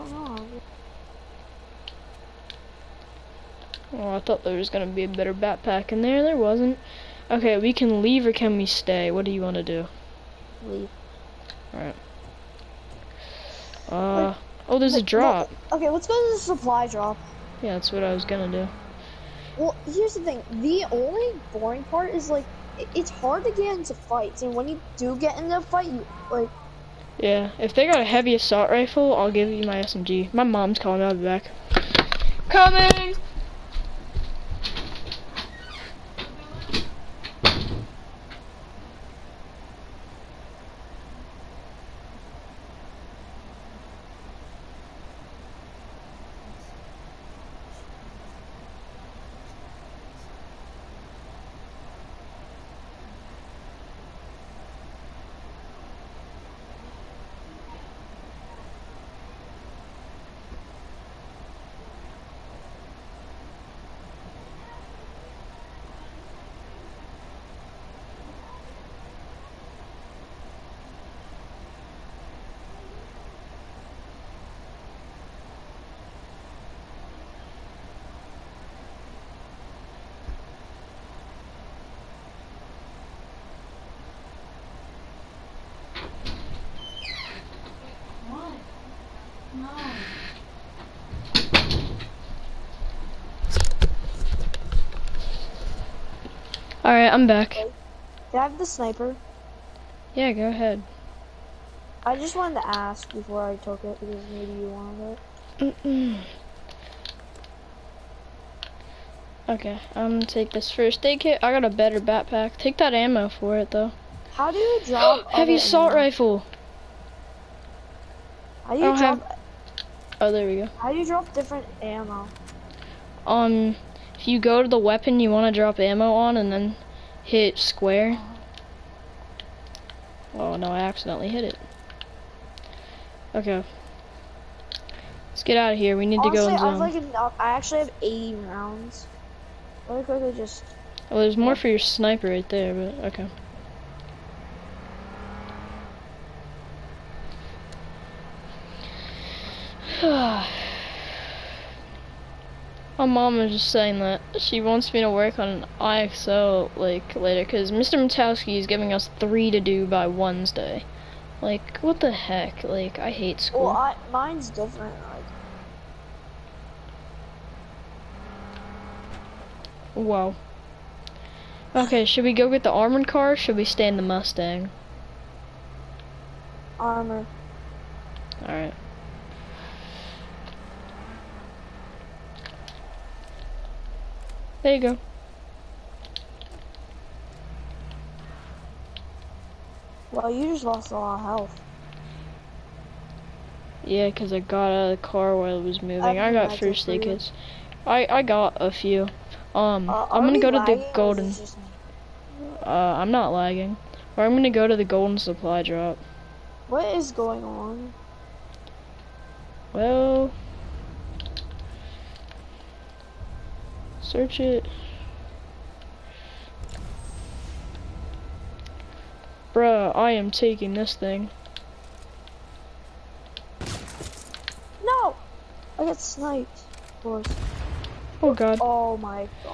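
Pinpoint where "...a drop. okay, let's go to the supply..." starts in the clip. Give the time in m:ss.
0:14.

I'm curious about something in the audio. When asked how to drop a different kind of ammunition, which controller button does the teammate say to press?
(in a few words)
Square.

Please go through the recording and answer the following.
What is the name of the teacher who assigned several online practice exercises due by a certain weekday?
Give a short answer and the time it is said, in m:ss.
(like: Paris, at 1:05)
Mr. Matowski, at 2:37.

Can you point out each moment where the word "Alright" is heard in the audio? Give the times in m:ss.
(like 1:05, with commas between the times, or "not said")
0:11, 1:36.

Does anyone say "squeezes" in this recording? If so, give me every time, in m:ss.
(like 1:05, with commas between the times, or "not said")
not said.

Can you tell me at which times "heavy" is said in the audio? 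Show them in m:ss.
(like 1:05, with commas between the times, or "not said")
0:28, 1:55.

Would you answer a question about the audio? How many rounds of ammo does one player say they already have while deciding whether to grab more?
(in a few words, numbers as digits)
80.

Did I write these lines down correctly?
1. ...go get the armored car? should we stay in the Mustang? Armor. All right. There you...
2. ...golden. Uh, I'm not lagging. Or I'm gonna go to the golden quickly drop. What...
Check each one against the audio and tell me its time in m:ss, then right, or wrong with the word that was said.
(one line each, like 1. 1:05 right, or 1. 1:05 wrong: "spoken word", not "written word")
1. 2:52 right
2. 3:20 wrong: "supply", not "quickly".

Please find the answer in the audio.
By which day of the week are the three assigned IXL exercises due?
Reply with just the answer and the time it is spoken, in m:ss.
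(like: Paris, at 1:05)
Wednesday, at 2:40.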